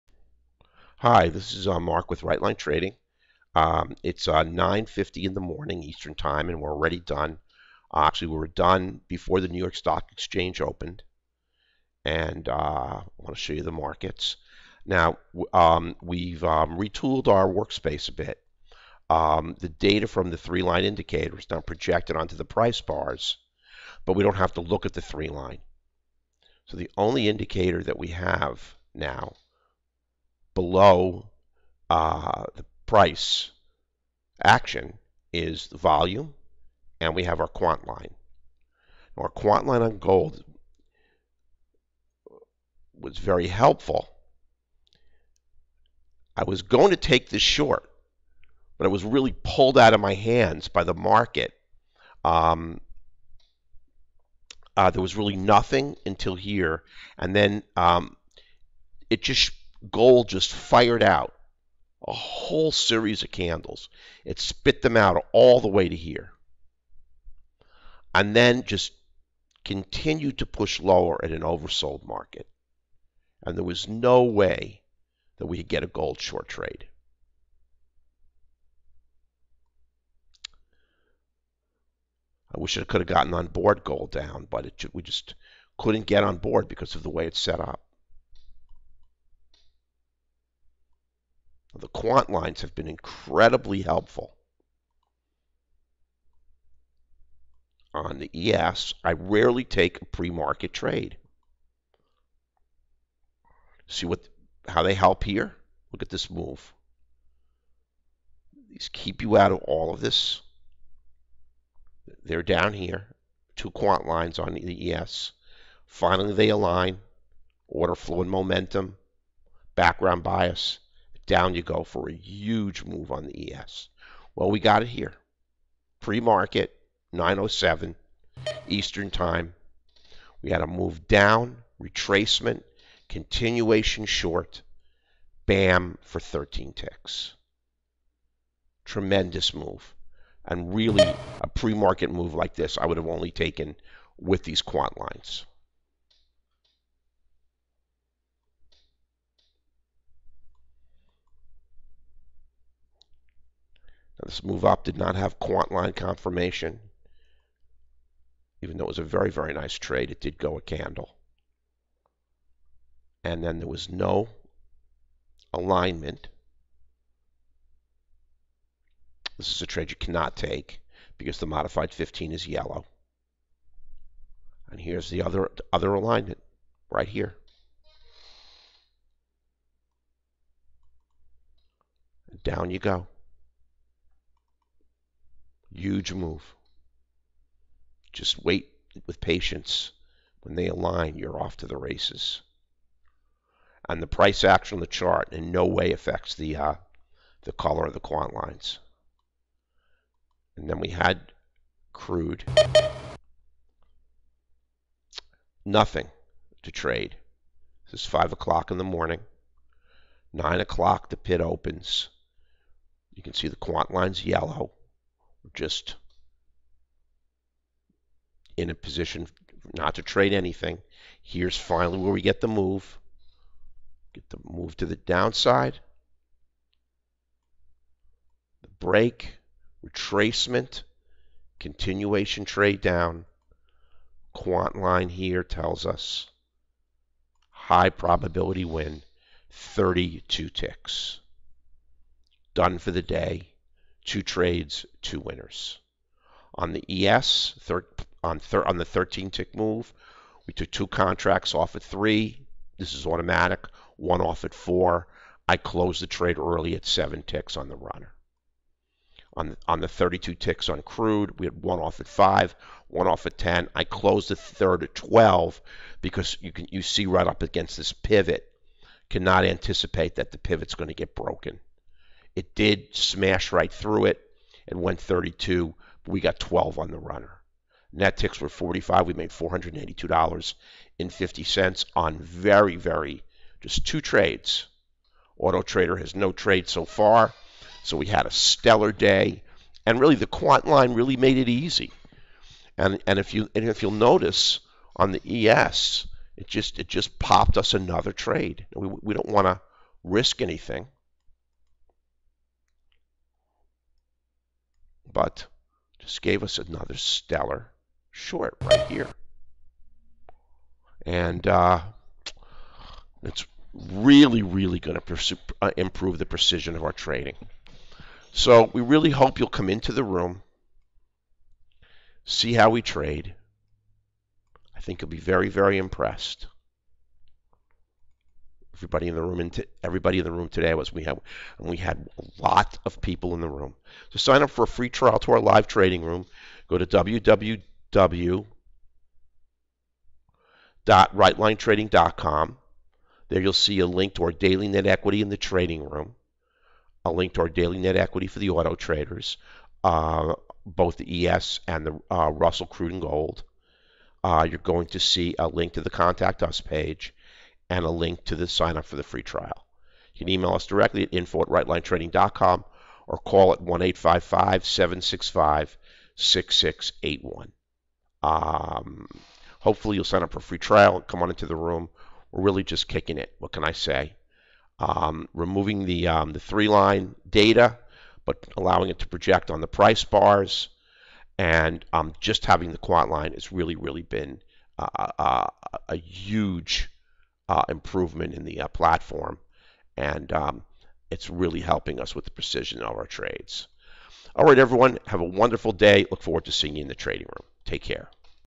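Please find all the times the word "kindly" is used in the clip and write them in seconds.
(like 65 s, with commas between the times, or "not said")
not said.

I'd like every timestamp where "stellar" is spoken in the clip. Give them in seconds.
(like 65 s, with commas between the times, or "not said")
288 s, 306 s.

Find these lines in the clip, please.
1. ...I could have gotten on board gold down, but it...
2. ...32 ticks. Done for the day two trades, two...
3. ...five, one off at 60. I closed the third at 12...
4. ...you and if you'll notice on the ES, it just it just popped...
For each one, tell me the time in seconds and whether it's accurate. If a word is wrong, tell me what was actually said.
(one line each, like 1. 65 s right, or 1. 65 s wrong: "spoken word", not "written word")
1. 82 s right
2. 239 s right
3. 262 s wrong: "10", not "60"
4. 293 s right.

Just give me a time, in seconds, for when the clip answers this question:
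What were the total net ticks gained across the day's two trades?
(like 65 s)
277 s.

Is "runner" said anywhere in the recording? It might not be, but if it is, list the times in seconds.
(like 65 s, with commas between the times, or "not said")
257 s, 276 s.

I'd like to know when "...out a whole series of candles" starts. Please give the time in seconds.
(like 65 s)
61 s.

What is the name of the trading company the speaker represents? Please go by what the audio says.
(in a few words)
Rightline Trading.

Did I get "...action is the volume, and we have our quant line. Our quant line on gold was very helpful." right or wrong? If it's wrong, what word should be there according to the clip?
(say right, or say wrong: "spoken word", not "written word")
right.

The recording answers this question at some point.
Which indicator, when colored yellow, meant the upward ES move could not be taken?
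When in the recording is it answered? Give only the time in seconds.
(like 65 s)
171 s.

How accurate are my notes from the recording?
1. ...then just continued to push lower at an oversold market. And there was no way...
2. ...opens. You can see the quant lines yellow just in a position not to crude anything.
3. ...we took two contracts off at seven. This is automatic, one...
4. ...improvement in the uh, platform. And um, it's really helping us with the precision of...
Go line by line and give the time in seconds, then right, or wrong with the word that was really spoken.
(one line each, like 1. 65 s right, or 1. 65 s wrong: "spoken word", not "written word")
1. 68 s right
2. 211 s wrong: "trade", not "crude"
3. 250 s wrong: "three", not "seven"
4. 387 s right.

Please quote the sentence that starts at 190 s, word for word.
When they align, you're off to the races.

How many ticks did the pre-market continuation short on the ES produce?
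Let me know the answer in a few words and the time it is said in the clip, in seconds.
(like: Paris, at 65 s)
13, at 136 s.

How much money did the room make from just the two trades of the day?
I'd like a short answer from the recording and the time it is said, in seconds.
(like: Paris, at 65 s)
$482.50, at 279 s.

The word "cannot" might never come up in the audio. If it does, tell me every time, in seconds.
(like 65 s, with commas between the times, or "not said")
169 s, 269 s.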